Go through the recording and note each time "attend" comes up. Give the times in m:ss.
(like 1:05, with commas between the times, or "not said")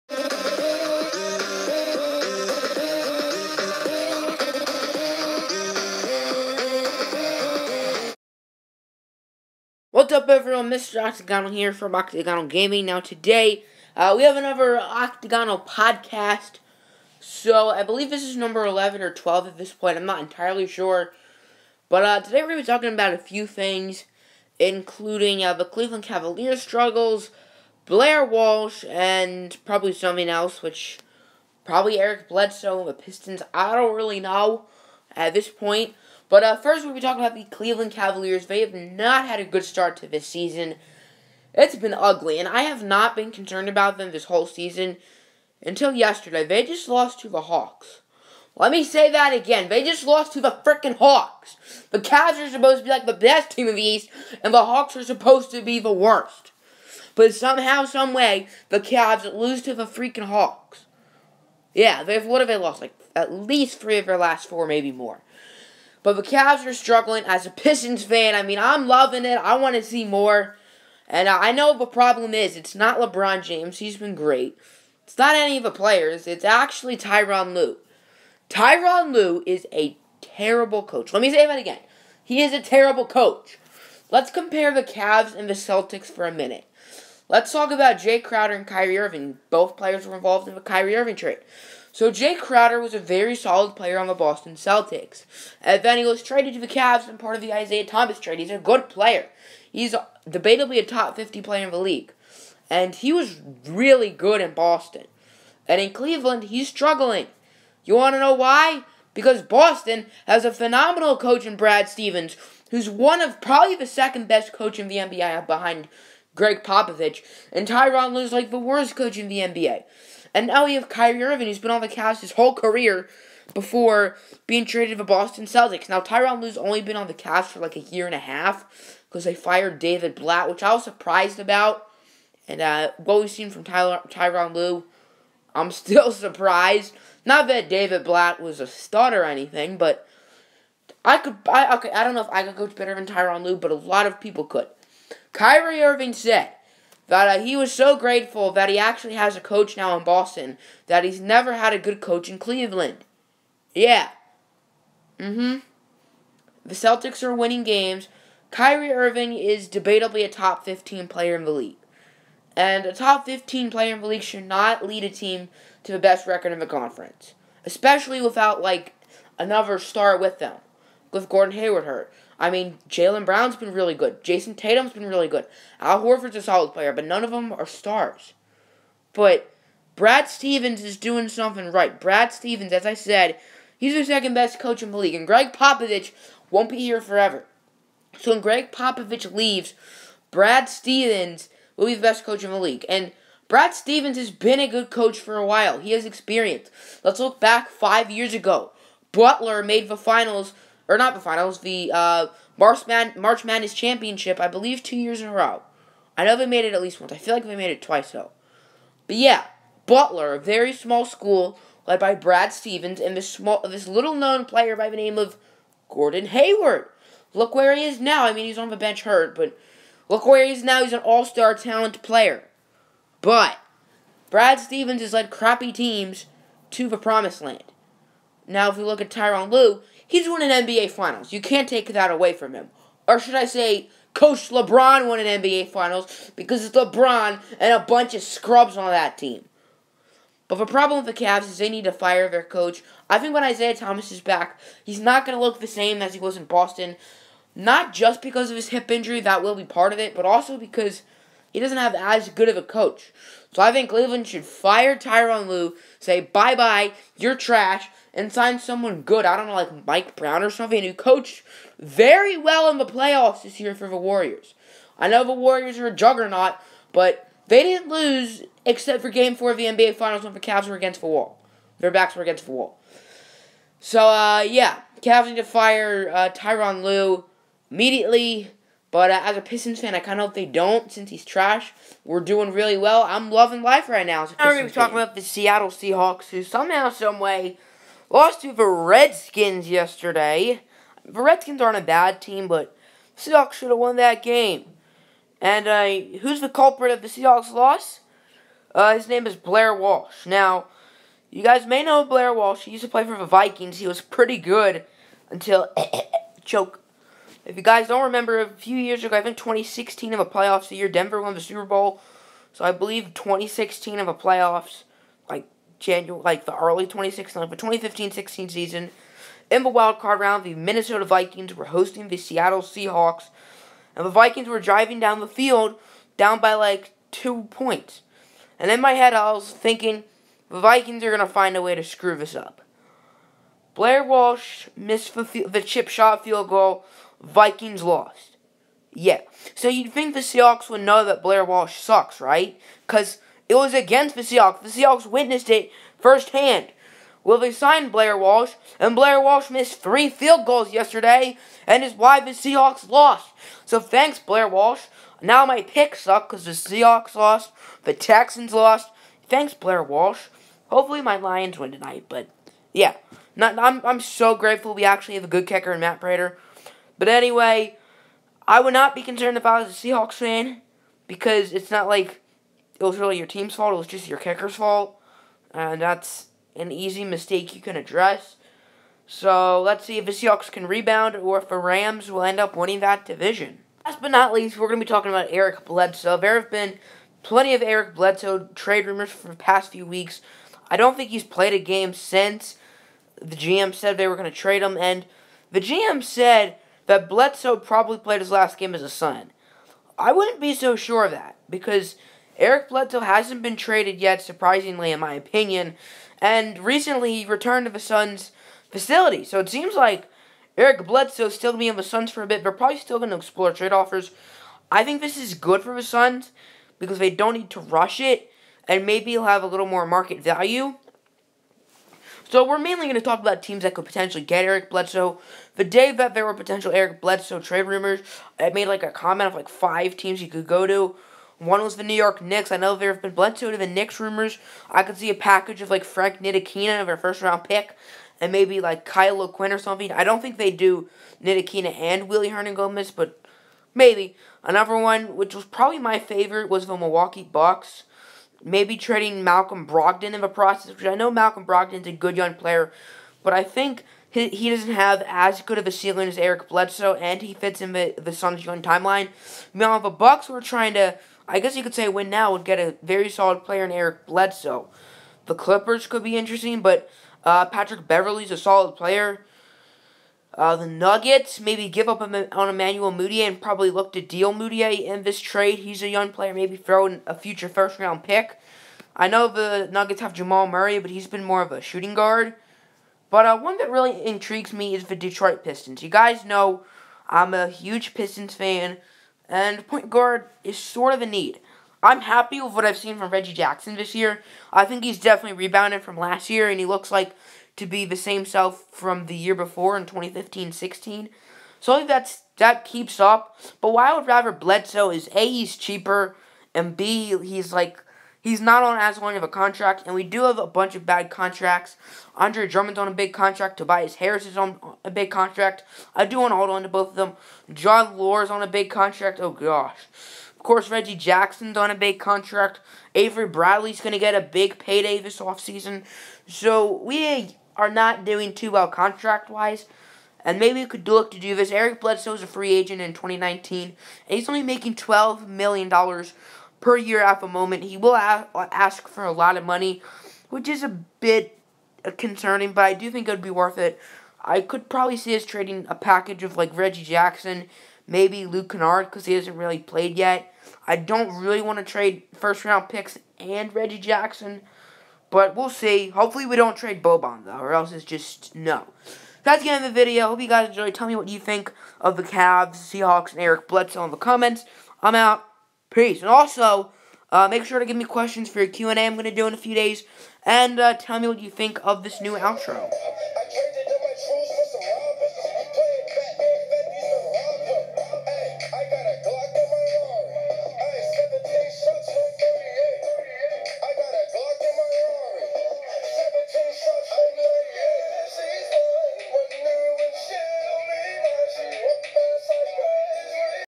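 not said.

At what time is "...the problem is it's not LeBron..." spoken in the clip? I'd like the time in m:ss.
1:11.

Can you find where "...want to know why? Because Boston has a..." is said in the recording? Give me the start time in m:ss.
1:47.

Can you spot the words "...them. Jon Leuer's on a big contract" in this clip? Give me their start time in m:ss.
8:36.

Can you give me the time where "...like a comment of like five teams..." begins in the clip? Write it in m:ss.
7:08.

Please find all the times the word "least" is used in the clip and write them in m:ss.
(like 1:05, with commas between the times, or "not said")
1:03, 3:26, 6:24.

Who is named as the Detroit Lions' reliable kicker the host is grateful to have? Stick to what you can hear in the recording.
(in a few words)
Matt Prater.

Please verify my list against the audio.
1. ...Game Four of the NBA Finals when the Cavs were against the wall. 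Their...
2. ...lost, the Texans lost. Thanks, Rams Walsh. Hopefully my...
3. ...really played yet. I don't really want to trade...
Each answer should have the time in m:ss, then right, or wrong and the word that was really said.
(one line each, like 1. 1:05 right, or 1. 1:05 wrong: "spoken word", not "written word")
1. 4:29 right
2. 5:57 wrong: "Blair", not "Rams"
3. 9:09 right.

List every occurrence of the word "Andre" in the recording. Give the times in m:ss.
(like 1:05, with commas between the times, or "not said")
8:32.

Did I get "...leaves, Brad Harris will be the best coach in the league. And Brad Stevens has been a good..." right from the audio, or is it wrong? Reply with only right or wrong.
wrong.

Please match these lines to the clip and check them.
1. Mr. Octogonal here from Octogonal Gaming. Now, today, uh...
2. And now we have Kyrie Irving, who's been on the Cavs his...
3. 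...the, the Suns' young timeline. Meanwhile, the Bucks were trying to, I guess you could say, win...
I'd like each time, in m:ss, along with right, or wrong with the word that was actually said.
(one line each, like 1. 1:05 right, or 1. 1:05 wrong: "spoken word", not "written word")
1. 0:10 right
2. 2:00 right
3. 7:37 right.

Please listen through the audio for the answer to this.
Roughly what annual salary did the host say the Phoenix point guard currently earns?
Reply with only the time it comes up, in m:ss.
8:54.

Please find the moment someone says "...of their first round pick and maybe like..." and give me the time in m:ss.
7:16.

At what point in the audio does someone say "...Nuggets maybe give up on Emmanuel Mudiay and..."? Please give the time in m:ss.
7:50.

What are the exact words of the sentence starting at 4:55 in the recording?
And uh, who's the culprit of the Seahawks' loss?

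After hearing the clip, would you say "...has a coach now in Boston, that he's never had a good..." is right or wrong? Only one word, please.
right.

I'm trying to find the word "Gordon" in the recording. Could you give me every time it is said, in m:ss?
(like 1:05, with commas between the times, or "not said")
2:51, 3:35.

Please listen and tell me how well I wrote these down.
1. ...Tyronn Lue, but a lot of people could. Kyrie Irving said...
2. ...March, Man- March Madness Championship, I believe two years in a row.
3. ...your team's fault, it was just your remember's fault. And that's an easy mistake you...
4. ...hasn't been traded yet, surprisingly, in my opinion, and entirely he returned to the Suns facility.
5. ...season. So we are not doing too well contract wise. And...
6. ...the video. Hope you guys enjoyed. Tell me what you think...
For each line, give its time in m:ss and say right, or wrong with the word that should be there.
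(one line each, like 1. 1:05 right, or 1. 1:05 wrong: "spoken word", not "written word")
1. 2:23 right
2. 3:22 right
3. 6:13 wrong: "kicker", not "remember"
4. 6:43 wrong: "recently", not "entirely"
5. 8:45 wrong: "offseason", not "season"
6. 9:19 right.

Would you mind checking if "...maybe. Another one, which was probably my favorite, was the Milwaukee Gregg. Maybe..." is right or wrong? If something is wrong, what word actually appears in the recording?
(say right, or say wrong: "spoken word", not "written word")
wrong: "Bucks", not "Gregg".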